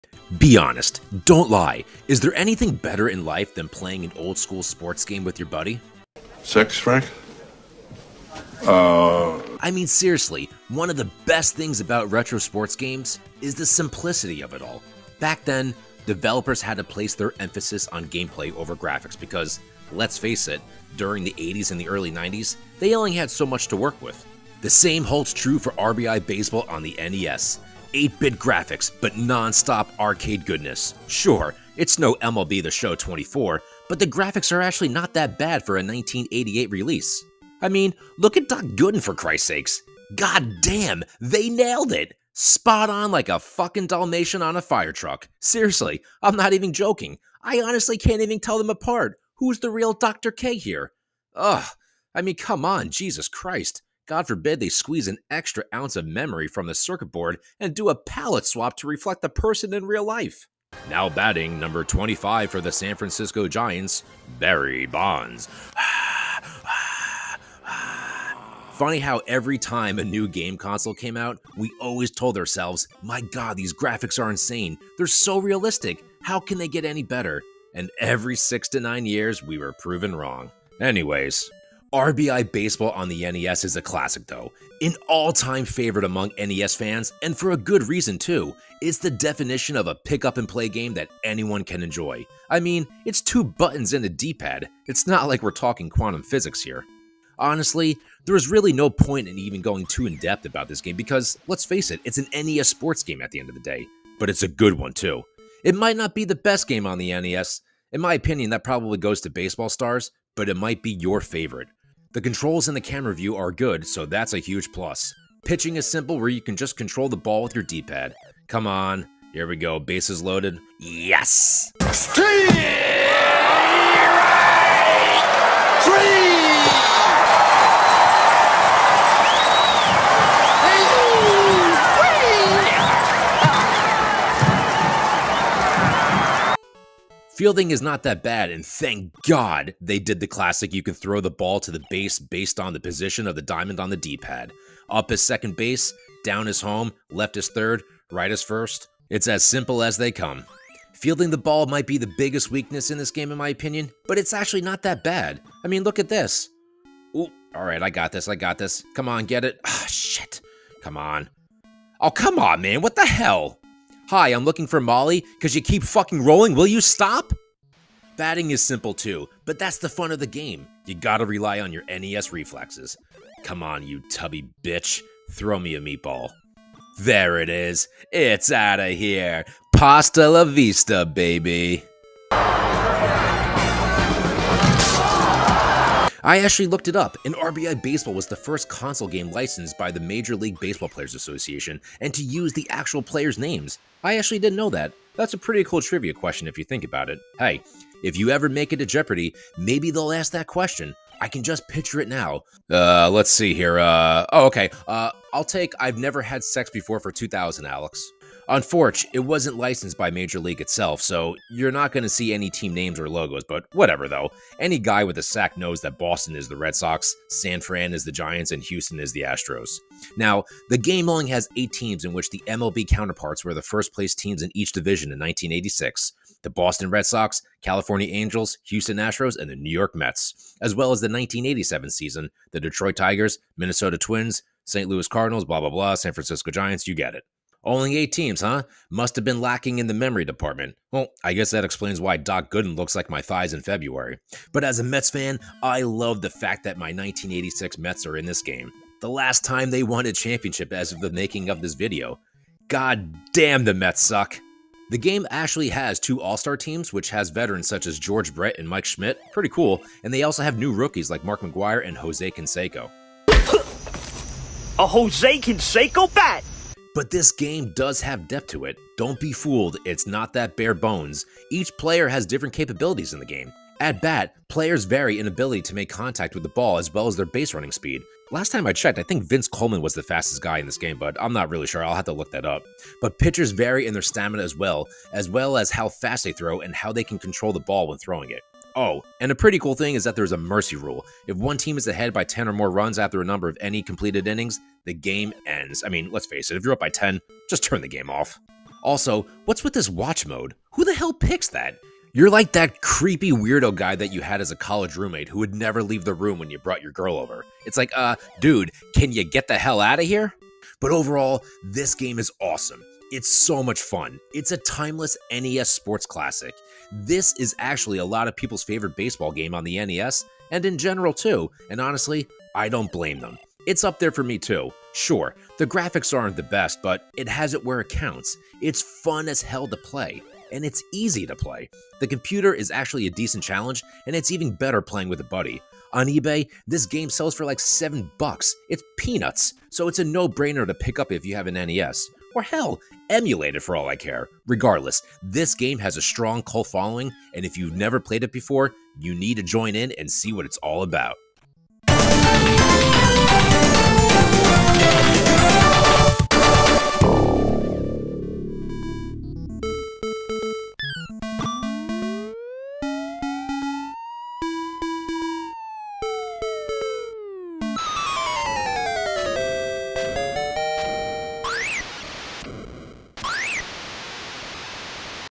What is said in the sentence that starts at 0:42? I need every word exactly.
Spot on like a fucking Dalmatian on a fire truck.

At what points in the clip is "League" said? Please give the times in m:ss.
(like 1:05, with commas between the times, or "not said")
3:10, 3:30.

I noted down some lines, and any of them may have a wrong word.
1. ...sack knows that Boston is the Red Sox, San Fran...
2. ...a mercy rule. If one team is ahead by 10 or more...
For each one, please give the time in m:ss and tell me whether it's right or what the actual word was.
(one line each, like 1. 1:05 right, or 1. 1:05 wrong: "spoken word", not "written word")
1. 3:35 right
2. 4:50 right.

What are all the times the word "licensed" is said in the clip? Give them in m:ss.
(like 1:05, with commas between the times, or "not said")
3:09, 3:29.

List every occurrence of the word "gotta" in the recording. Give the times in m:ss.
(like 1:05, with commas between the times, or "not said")
2:50.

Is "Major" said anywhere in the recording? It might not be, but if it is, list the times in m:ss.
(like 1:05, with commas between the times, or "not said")
3:09, 3:30.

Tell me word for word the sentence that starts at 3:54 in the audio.
Louis Cardinals, blah, blah, blah, San Francisco Giants, you get it.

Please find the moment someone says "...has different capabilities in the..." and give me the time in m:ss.
4:32.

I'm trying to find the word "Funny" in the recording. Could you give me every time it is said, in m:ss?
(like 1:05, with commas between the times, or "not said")
1:08.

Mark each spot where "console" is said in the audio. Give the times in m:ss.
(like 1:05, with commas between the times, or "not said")
1:10, 3:08.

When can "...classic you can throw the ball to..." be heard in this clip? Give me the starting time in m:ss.
2:20.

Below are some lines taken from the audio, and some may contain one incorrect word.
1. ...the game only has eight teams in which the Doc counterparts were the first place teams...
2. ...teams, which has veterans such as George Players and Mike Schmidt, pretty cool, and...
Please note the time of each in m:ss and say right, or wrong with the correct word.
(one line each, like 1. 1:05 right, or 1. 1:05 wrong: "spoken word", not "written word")
1. 3:40 wrong: "MLB", not "Doc"
2. 4:16 wrong: "Brett", not "Players".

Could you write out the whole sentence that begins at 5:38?
It's peanuts, so it's a no-brainer to pick up if you have an NES or hell, emulate it for all I care.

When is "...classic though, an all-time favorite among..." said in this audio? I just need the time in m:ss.
1:23.